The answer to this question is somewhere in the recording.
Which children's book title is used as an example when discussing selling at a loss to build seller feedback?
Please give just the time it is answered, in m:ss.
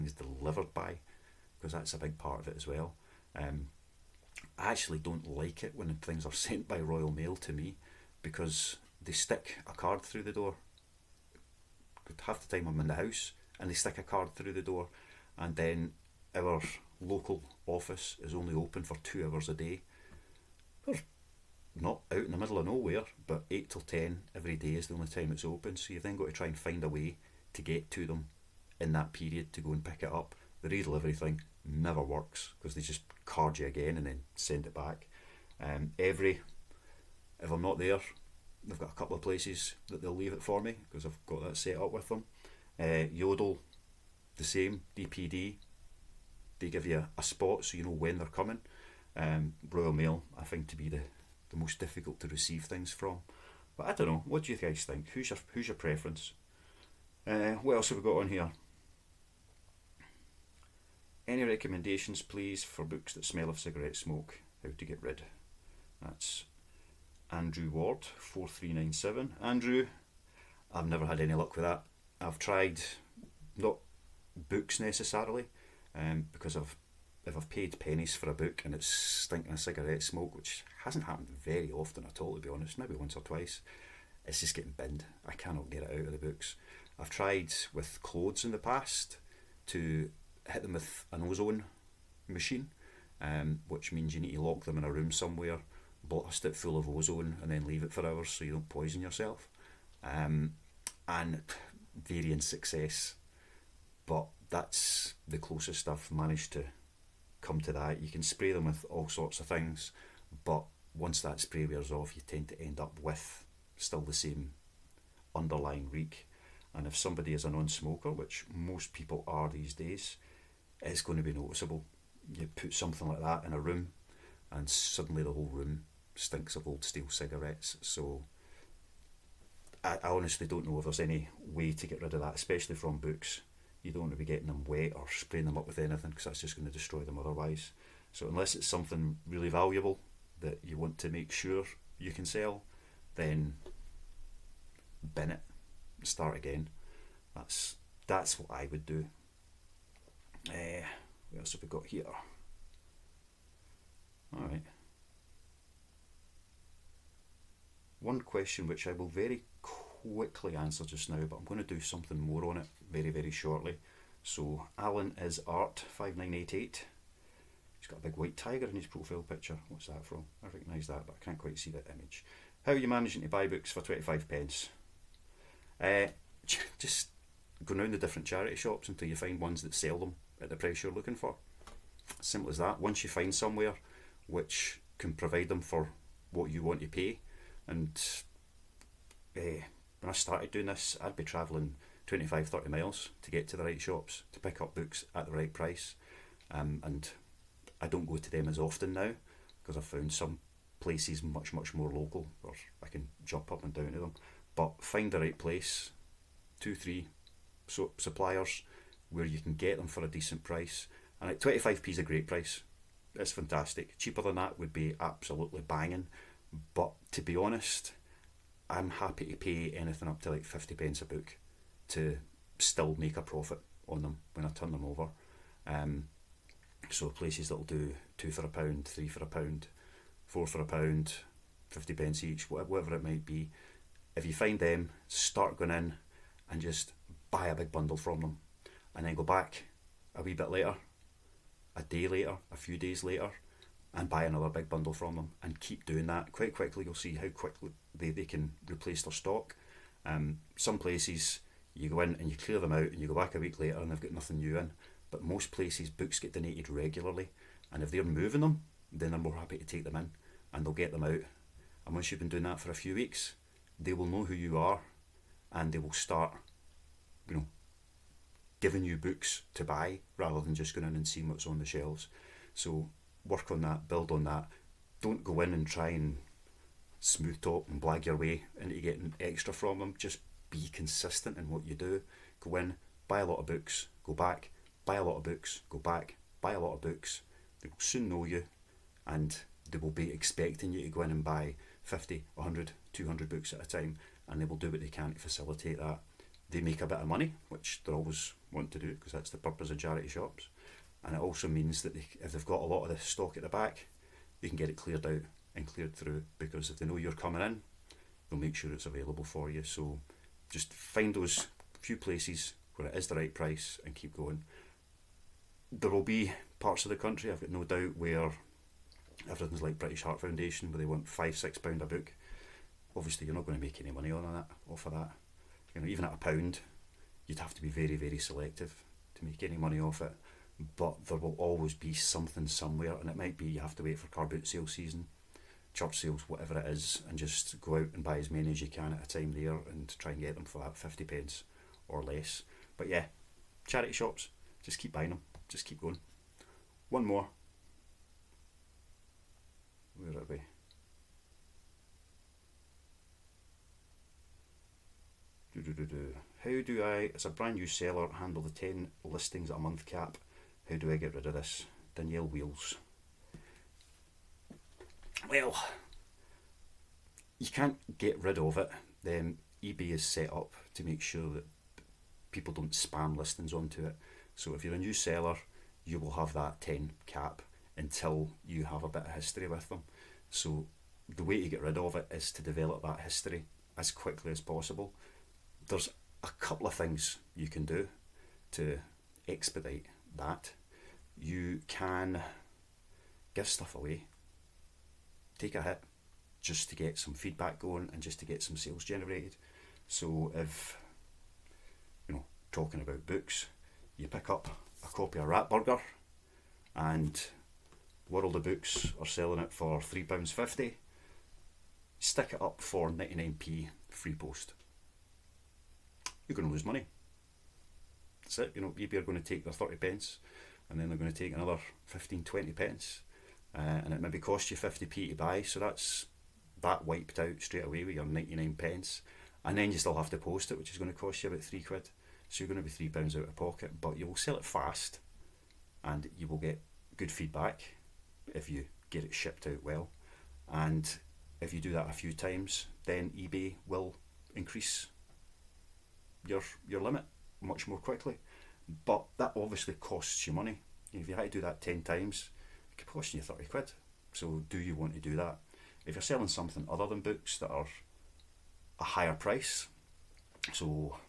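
6:45.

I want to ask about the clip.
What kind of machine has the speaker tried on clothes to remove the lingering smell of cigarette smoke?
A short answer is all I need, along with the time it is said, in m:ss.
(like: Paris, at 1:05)
ozone machine, at 1:31.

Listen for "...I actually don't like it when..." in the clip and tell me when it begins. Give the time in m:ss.
0:04.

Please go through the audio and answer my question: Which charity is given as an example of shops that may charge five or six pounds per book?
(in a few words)
British Heart Foundation.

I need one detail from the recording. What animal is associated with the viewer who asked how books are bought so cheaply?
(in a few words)
white tiger.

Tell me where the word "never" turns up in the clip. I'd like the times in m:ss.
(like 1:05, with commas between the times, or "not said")
0:31, 1:10.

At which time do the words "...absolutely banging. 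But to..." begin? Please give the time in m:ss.
3:34.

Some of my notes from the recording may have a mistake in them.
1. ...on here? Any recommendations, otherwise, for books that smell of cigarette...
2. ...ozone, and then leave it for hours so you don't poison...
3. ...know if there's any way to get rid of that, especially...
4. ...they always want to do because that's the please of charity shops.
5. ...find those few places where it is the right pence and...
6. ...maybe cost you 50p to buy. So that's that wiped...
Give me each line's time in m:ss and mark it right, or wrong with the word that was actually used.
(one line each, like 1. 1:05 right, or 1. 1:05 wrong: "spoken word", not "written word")
1. 0:58 wrong: "please", not "otherwise"
2. 1:36 right
3. 2:10 right
4. 4:57 wrong: "purpose", not "please"
5. 5:10 wrong: "price", not "pence"
6. 7:03 right.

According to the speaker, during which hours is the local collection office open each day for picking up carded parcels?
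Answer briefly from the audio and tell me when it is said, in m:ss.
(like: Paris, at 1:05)
8 till 10, at 0:23.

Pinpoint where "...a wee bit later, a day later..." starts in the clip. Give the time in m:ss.
4:00.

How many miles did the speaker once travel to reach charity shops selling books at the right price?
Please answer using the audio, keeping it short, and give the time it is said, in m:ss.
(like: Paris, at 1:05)
25, 30 miles, at 3:12.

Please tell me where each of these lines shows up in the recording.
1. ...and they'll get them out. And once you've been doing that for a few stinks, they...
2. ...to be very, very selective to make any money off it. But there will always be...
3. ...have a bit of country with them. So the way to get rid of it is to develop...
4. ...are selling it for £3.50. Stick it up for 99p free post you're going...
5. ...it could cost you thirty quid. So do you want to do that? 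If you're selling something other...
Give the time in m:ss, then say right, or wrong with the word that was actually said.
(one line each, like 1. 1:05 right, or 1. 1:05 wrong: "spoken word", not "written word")
1. 4:20 wrong: "weeks", not "stinks"
2. 5:27 right
3. 6:18 wrong: "history", not "country"
4. 6:48 right
5. 7:32 right.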